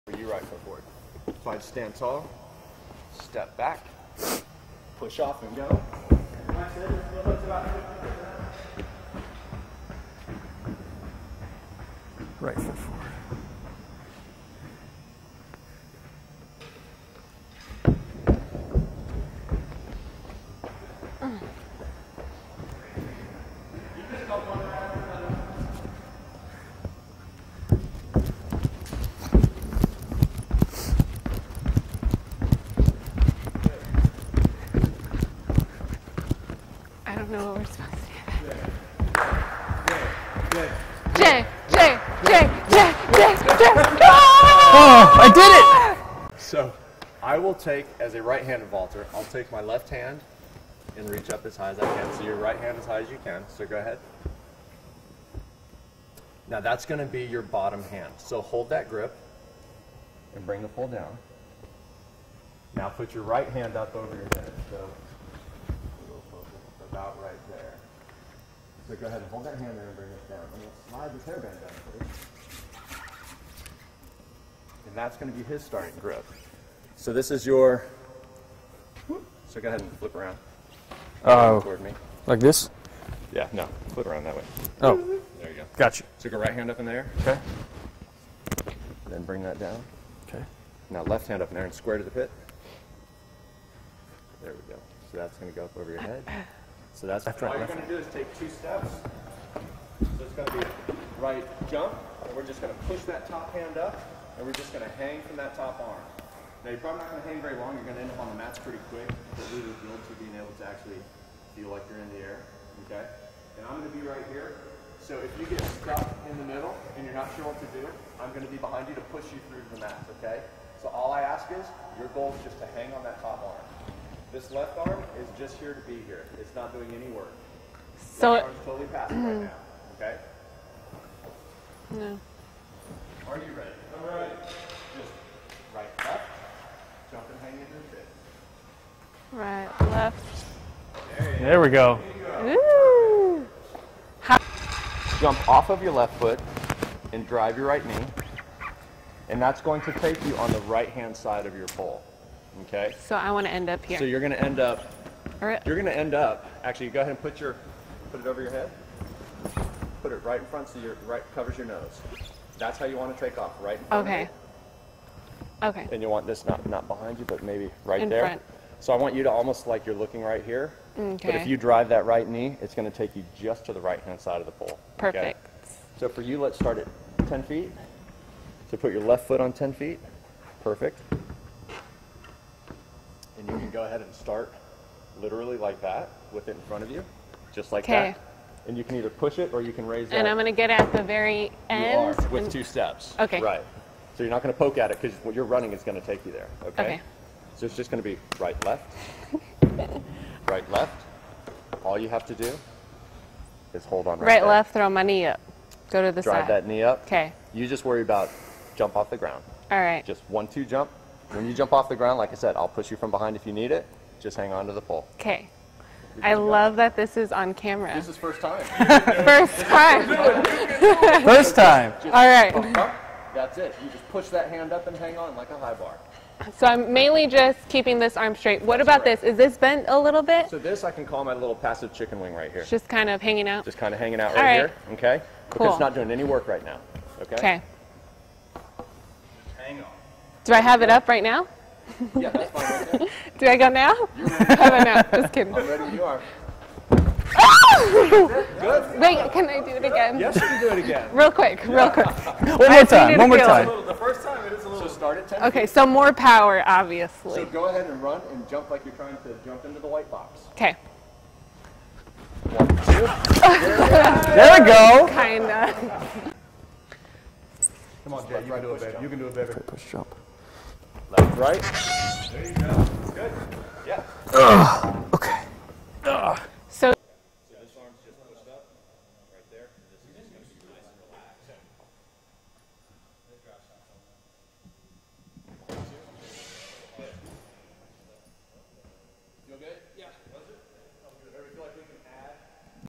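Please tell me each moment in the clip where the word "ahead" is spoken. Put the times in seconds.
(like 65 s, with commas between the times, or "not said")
53 s, 69 s, 79 s, 157 s, 183 s, 257 s.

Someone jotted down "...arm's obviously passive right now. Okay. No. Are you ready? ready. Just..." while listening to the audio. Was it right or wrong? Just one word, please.
wrong.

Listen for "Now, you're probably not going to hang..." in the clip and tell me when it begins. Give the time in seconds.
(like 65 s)
106 s.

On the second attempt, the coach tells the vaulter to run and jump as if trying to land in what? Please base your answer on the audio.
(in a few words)
the white box.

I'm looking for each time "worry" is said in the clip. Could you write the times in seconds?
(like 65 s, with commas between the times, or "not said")
207 s.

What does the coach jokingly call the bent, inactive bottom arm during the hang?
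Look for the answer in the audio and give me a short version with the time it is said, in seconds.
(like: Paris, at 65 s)
passive chicken wing, at 231 s.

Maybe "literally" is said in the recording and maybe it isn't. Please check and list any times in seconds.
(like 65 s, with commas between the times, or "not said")
185 s.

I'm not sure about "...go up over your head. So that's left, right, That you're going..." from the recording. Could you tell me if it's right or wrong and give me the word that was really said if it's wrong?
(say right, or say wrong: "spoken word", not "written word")
wrong: "All", not "That".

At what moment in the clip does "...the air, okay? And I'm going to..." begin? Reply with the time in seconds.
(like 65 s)
112 s.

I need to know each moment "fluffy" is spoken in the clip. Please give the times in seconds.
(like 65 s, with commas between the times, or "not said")
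not said.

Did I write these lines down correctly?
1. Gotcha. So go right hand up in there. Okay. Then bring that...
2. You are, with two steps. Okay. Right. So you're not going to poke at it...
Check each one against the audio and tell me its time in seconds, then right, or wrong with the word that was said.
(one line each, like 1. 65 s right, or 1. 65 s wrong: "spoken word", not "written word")
1. 85 s right
2. 192 s right.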